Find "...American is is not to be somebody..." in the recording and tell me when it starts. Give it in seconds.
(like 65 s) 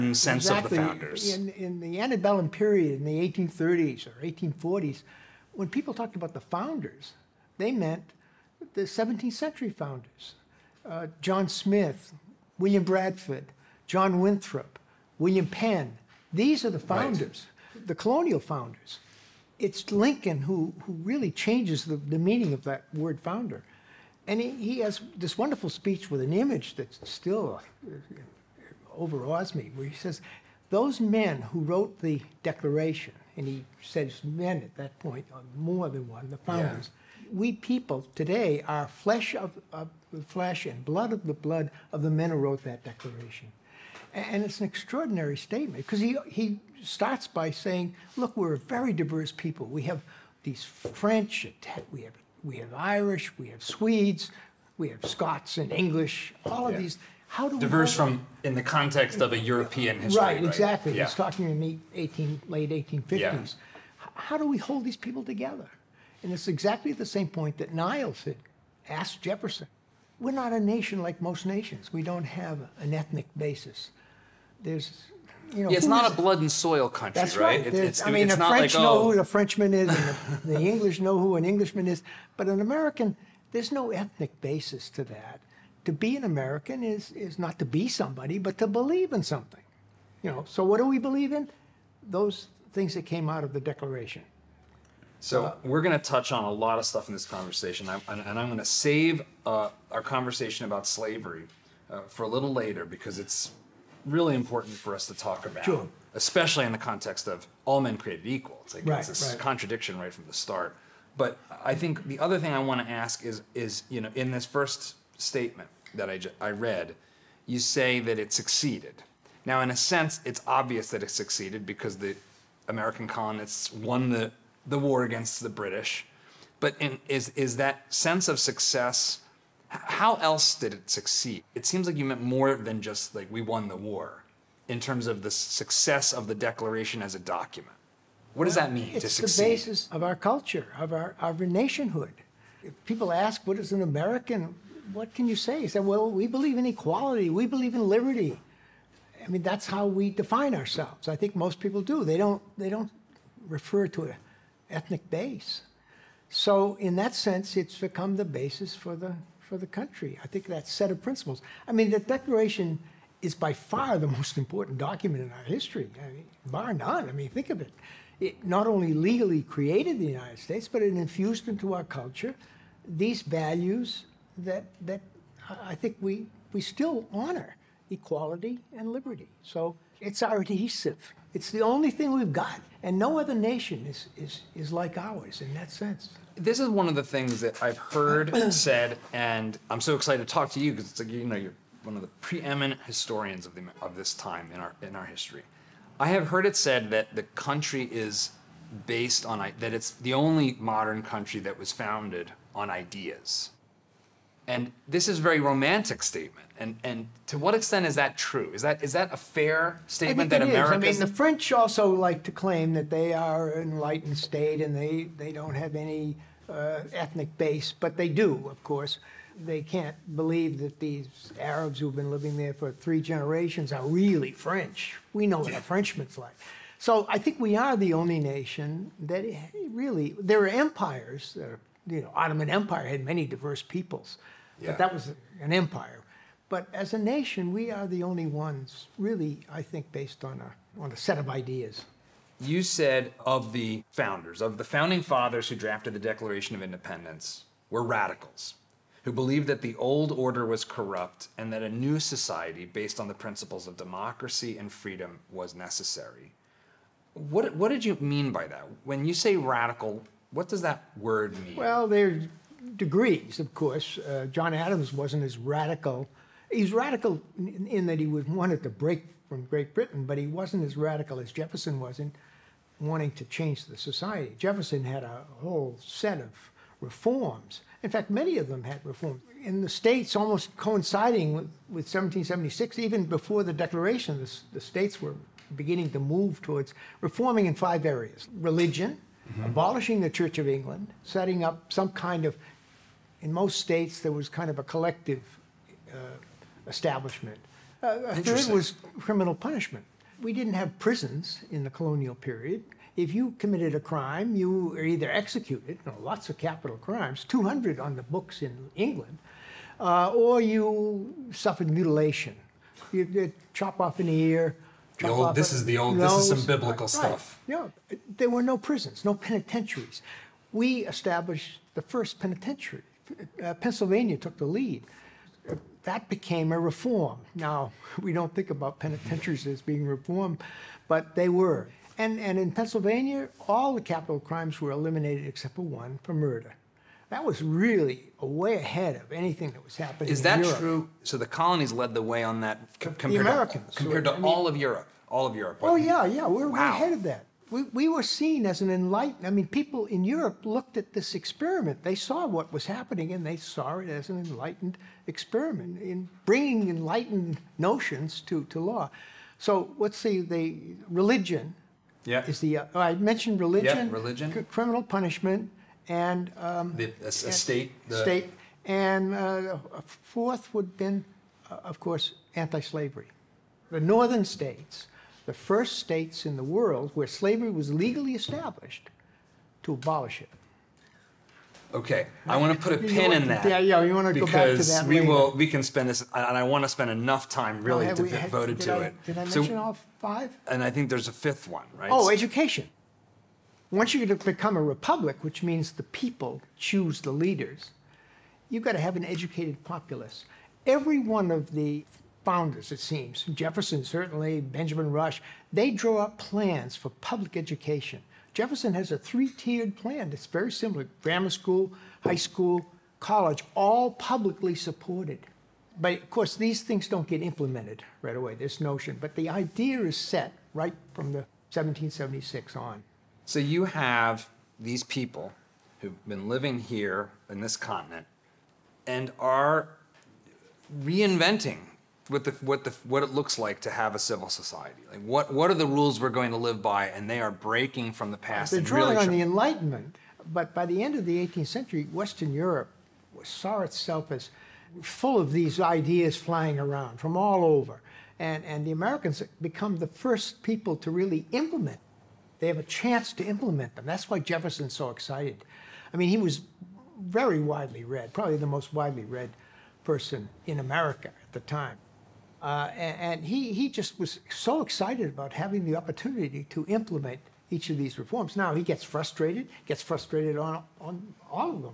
86 s.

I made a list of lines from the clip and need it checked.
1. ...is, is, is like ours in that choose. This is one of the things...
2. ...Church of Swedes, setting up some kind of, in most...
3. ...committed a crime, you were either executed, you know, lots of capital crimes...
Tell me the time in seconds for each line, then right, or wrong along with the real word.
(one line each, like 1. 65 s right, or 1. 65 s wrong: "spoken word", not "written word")
1. 183 s wrong: "sense", not "choose"
2. 290 s wrong: "England", not "Swedes"
3. 303 s right.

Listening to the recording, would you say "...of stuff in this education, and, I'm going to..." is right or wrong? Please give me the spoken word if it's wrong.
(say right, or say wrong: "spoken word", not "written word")
wrong: "conversation", not "education".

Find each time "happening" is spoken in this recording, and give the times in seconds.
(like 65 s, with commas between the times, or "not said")
339 s, 352 s.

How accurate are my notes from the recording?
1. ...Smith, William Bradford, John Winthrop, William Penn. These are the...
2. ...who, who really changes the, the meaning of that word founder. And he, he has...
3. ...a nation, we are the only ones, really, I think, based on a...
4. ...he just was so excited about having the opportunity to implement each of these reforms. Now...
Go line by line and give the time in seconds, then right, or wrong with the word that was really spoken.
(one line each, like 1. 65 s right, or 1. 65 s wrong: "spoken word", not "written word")
1. 11 s right
2. 20 s right
3. 236 s right
4. 463 s right.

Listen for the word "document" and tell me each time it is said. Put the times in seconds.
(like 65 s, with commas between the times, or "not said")
137 s, 164 s.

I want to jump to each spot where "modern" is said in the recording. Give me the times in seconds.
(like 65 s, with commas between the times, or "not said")
200 s.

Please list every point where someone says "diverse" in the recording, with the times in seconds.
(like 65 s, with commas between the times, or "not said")
48 s, 57 s, 233 s.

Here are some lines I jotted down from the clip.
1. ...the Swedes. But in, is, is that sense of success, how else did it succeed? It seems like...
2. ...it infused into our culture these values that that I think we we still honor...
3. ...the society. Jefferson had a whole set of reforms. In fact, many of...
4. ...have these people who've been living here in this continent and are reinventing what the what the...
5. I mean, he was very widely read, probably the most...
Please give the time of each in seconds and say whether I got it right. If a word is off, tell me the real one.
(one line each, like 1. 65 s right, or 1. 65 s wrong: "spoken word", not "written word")
1. 125 s wrong: "British", not "Swedes"
2. 170 s right
3. 273 s right
4. 423 s right
5. 455 s right.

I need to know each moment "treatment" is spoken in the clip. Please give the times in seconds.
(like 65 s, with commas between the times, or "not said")
not said.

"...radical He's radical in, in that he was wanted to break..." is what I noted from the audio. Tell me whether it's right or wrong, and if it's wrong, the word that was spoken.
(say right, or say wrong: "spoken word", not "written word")
right.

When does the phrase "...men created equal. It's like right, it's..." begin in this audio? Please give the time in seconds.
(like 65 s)
107 s.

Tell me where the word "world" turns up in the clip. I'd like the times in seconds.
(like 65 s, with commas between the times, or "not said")
376 s.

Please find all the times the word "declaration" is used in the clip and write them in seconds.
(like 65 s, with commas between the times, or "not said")
32 s, 42 s, 93 s, 136 s, 161 s, 245 s, 283 s.